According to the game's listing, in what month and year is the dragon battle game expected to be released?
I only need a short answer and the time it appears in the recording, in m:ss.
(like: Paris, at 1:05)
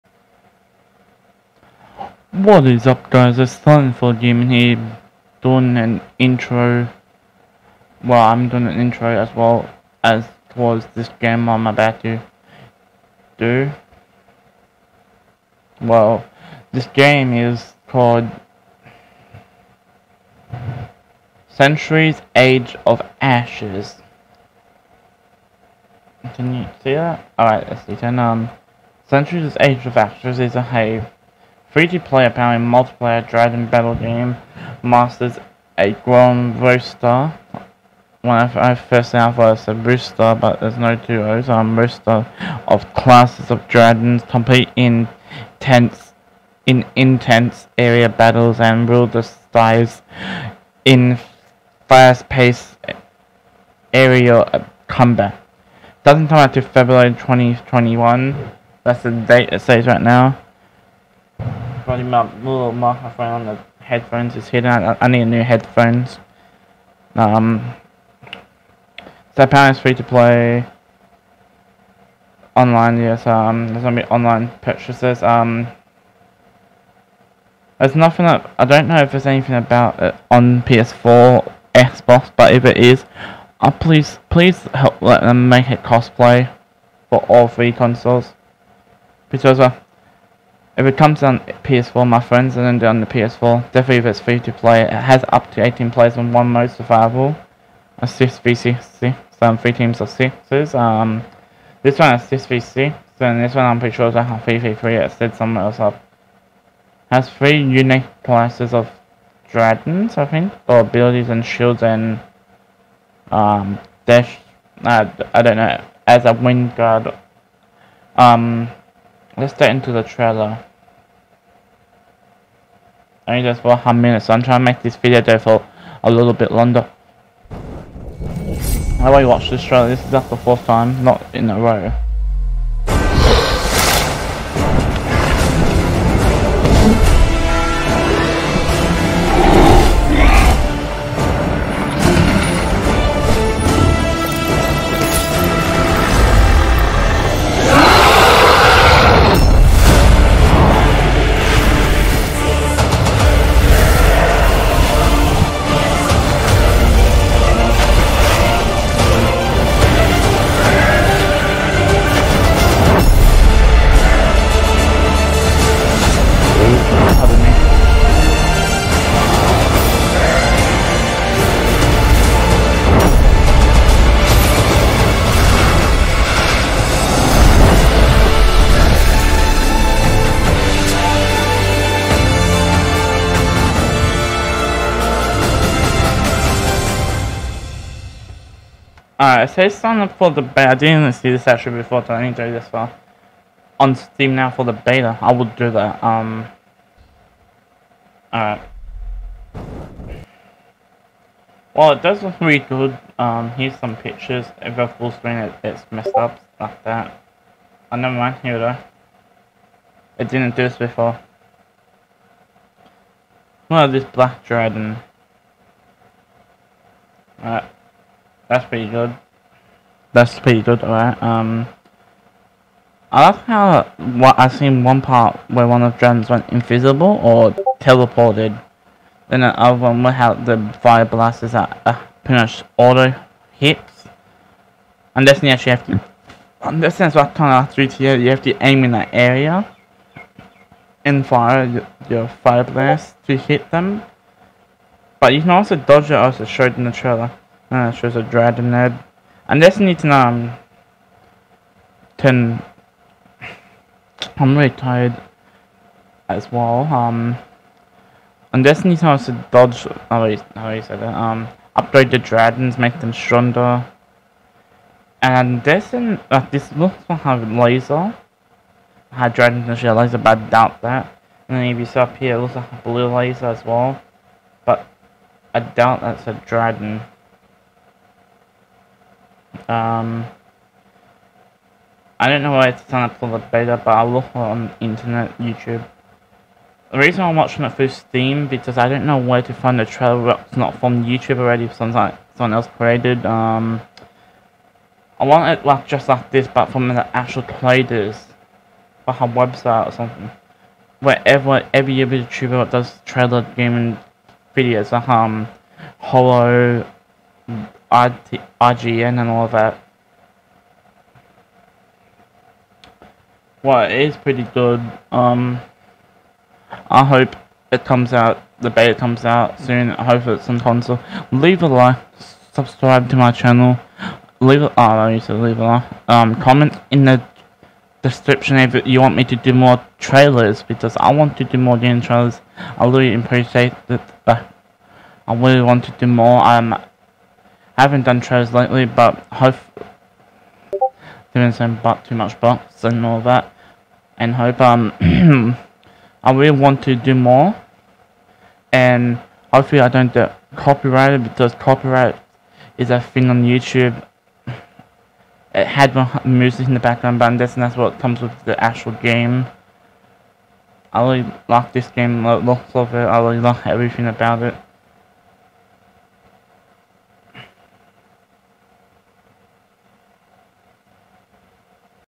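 February 2021, at 0:56.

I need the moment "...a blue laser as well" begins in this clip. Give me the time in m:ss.
4:32.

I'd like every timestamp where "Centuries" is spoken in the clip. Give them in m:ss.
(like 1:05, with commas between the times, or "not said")
0:21, 0:29.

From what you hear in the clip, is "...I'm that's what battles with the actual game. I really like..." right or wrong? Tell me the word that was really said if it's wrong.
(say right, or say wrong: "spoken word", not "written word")
wrong: "comes", not "battles".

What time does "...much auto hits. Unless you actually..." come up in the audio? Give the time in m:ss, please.
3:52.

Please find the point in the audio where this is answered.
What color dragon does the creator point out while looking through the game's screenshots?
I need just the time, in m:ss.
3:34.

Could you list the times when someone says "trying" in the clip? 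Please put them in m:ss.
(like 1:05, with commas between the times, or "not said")
2:04, 4:42.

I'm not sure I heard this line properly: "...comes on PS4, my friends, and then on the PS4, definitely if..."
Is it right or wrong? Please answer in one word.
right.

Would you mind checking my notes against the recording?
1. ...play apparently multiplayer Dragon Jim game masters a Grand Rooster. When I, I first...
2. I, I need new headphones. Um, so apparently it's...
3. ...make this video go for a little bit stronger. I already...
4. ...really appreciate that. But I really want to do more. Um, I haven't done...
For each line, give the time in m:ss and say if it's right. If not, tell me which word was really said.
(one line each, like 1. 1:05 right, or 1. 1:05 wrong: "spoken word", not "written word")
1. 0:32 wrong: "Battle", not "Jim"
2. 1:04 right
3. 2:04 wrong: "longer", not "stronger"
4. 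5:32 right.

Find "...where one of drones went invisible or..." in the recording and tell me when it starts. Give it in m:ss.
3:45.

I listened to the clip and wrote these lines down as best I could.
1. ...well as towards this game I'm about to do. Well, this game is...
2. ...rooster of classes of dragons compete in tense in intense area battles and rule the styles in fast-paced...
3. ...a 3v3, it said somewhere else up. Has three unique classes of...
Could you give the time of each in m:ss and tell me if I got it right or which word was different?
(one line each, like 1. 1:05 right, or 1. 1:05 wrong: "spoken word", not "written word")
1. 0:09 right
2. 0:41 right
3. 1:44 right.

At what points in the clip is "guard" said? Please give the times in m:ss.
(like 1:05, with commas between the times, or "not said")
1:56.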